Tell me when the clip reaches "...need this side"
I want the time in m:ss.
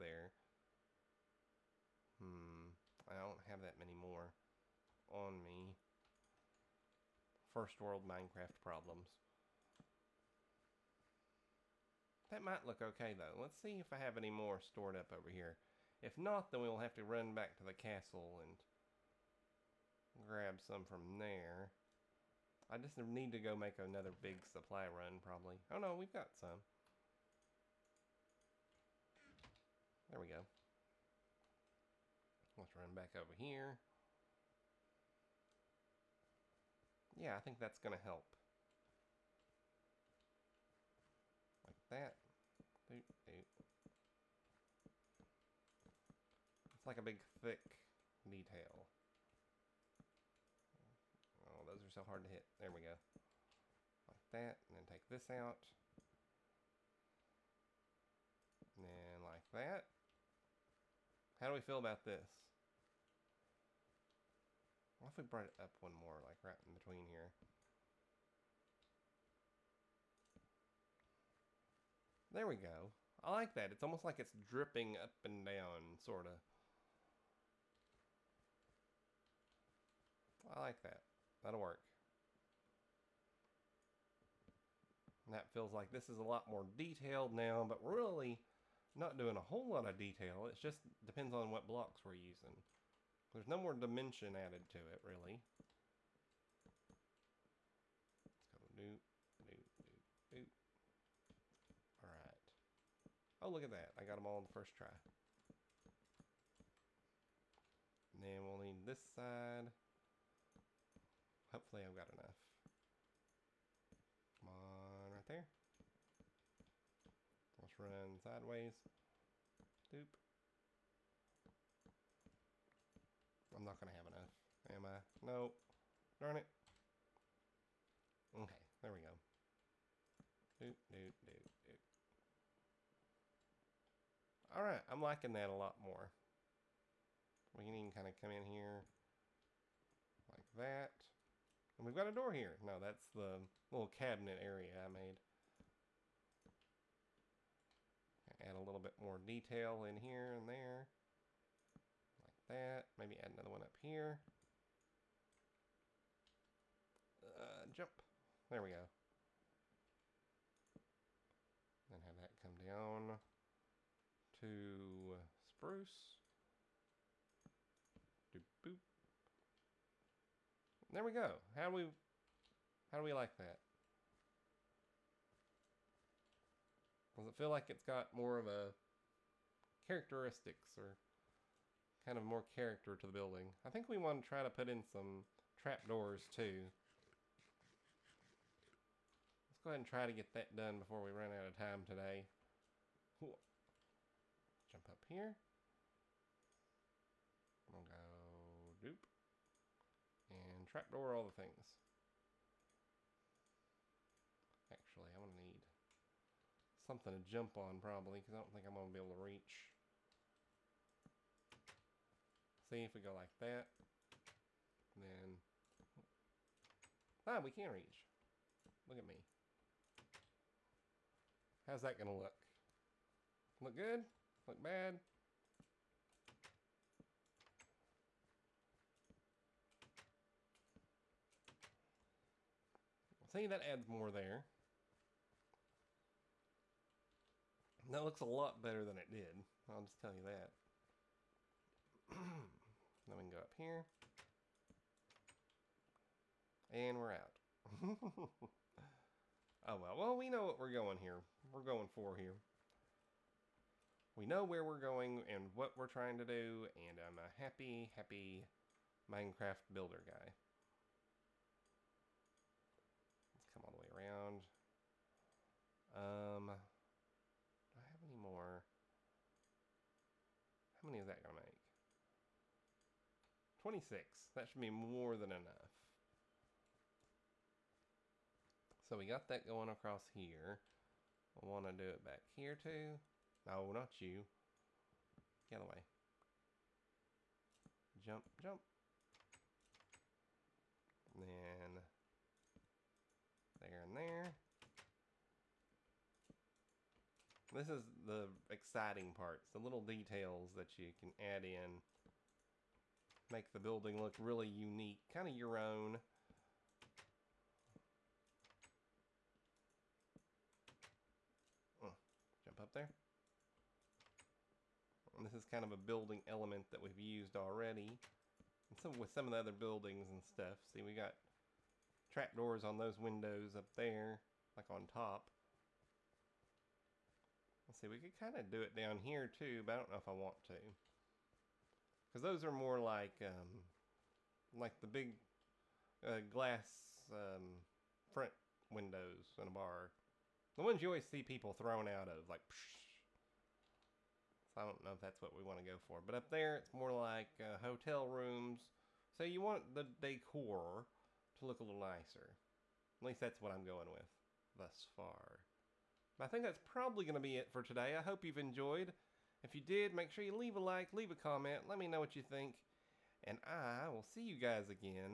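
1:48.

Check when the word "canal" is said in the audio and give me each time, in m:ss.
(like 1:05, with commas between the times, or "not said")
not said.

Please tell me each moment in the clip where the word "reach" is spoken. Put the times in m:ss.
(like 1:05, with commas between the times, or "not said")
3:29, 3:37.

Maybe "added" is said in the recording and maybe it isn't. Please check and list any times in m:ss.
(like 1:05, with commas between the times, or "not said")
1:34.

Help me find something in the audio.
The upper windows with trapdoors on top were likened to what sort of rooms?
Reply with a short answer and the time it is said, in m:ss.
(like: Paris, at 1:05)
hotel rooms, at 5:47.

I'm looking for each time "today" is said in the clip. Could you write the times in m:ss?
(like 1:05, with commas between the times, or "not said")
3:11, 5:57.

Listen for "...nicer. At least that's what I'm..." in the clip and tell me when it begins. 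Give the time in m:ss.
5:51.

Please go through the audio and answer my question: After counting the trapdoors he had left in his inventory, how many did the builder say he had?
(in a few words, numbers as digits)
26.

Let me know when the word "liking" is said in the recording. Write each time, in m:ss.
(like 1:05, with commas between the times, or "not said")
2:15.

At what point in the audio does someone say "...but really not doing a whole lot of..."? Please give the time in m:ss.
1:27.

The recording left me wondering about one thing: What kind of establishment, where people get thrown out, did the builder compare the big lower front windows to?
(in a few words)
a bar.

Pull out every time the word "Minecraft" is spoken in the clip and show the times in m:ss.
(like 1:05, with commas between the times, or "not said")
0:08, 4:19.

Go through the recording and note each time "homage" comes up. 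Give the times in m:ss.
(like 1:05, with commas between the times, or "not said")
not said.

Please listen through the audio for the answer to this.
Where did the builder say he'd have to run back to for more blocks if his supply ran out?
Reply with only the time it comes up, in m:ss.
0:17.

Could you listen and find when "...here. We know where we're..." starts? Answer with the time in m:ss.
4:12.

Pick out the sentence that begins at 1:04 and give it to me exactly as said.
What if we brought it up one more, like right in between here?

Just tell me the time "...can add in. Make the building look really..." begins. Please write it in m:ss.
5:00.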